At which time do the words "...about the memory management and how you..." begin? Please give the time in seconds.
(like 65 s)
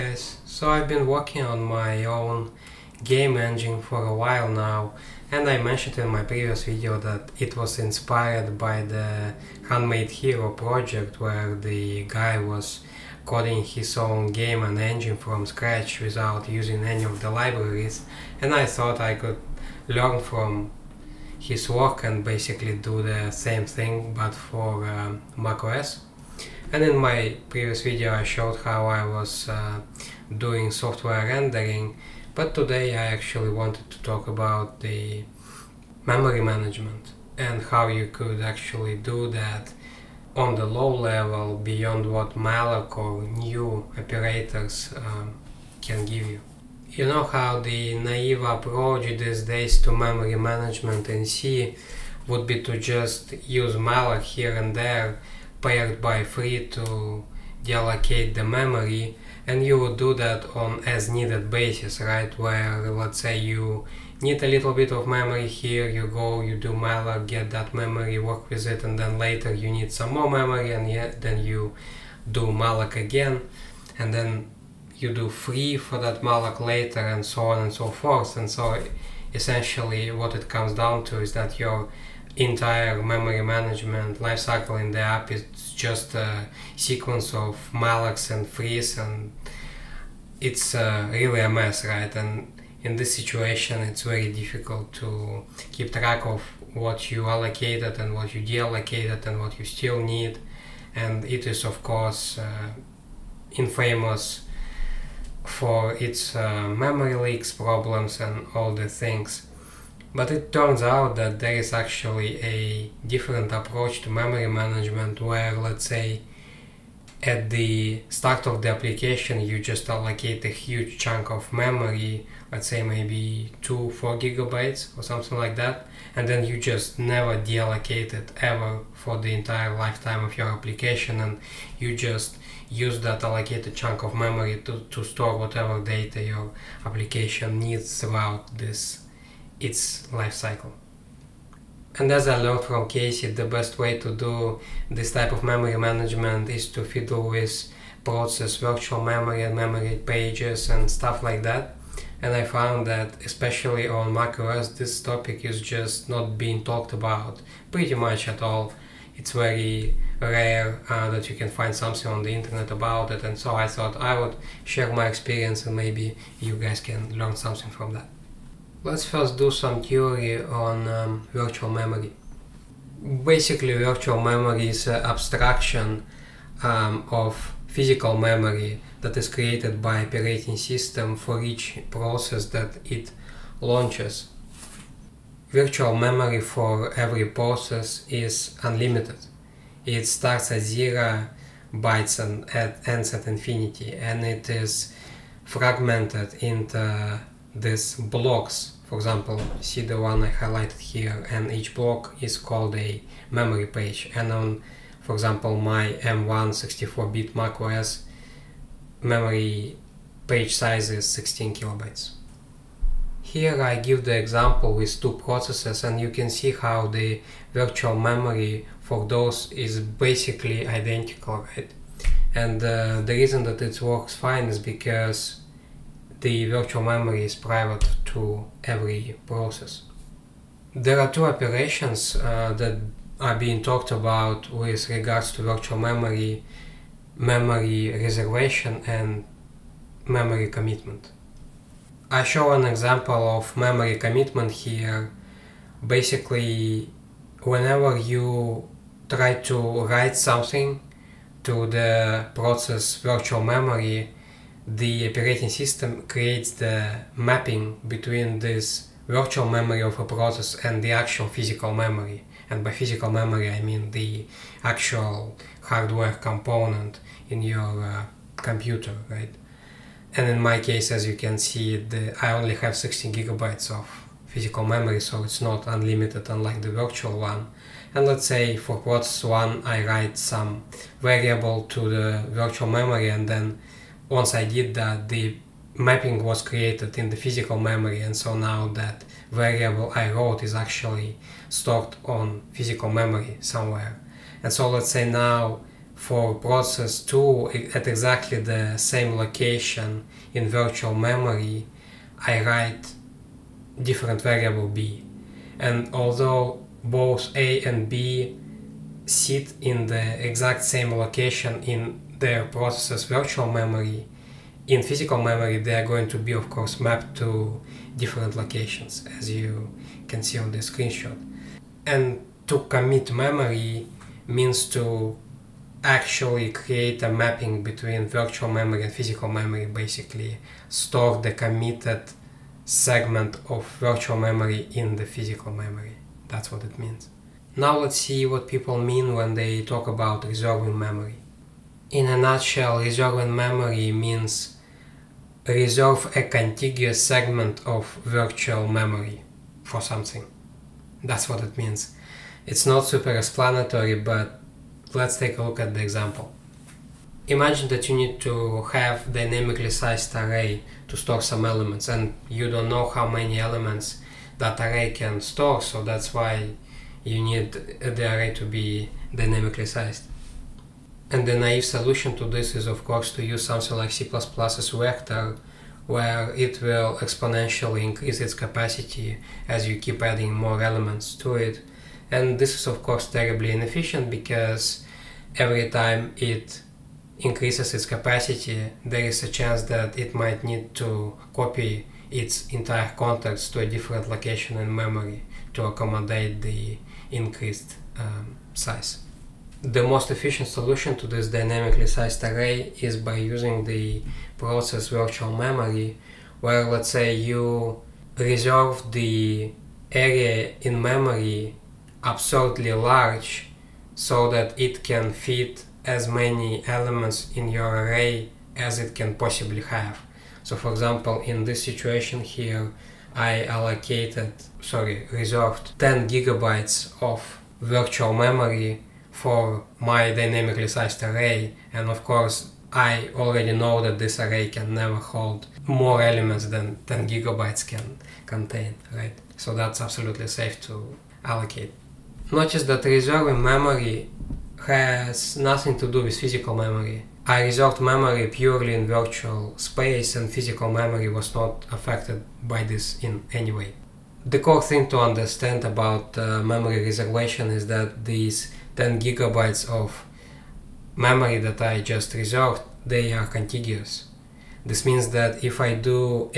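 34 s.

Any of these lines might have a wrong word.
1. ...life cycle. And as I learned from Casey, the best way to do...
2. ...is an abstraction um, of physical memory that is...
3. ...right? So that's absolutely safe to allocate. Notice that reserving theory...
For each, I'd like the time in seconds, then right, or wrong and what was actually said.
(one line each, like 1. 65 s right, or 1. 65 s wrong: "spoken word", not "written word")
1. 140 s right
2. 174 s right
3. 438 s wrong: "memory", not "theory".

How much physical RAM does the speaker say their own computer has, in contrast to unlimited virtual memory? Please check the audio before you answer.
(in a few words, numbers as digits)
16 gigabytes.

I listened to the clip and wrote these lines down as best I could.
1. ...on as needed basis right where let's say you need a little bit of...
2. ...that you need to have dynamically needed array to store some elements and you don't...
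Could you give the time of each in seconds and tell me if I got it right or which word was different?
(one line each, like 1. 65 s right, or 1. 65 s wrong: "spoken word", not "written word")
1. 60 s right
2. 357 s wrong: "sized", not "needed".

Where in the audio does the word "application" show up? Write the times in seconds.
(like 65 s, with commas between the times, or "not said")
118 s, 130 s, 136 s.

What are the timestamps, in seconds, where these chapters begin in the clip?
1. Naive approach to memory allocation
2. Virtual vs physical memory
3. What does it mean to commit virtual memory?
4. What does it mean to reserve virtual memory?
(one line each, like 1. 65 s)
1. 46 s
2. 167 s
3. 240 s
4. 339 s.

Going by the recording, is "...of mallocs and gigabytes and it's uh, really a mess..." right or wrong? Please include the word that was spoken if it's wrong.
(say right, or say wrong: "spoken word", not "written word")
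wrong: "frees", not "gigabytes".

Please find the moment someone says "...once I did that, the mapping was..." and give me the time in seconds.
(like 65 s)
284 s.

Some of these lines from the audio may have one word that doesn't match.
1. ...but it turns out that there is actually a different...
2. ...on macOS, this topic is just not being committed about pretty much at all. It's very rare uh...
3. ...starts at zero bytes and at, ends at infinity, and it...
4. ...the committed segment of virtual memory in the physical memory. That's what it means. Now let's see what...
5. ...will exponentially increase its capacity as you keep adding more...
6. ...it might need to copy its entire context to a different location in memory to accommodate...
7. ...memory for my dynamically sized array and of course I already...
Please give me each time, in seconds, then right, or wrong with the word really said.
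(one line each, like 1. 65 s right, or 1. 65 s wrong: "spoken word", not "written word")
1. 110 s right
2. 153 s wrong: "talked", not "committed"
3. 190 s right
4. 331 s right
5. 376 s right
6. 389 s right
7. 428 s right.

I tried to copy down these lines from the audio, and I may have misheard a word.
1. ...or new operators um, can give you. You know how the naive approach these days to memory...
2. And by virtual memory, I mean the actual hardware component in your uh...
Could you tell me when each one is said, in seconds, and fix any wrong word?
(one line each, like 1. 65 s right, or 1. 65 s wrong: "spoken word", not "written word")
1. 42 s right
2. 262 s wrong: "physical", not "virtual".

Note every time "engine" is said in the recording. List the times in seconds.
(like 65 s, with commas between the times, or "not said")
3 s, 14 s.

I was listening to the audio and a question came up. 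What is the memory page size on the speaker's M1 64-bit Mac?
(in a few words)
16 kilobytes.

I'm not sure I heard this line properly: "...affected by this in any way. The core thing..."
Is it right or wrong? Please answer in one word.
right.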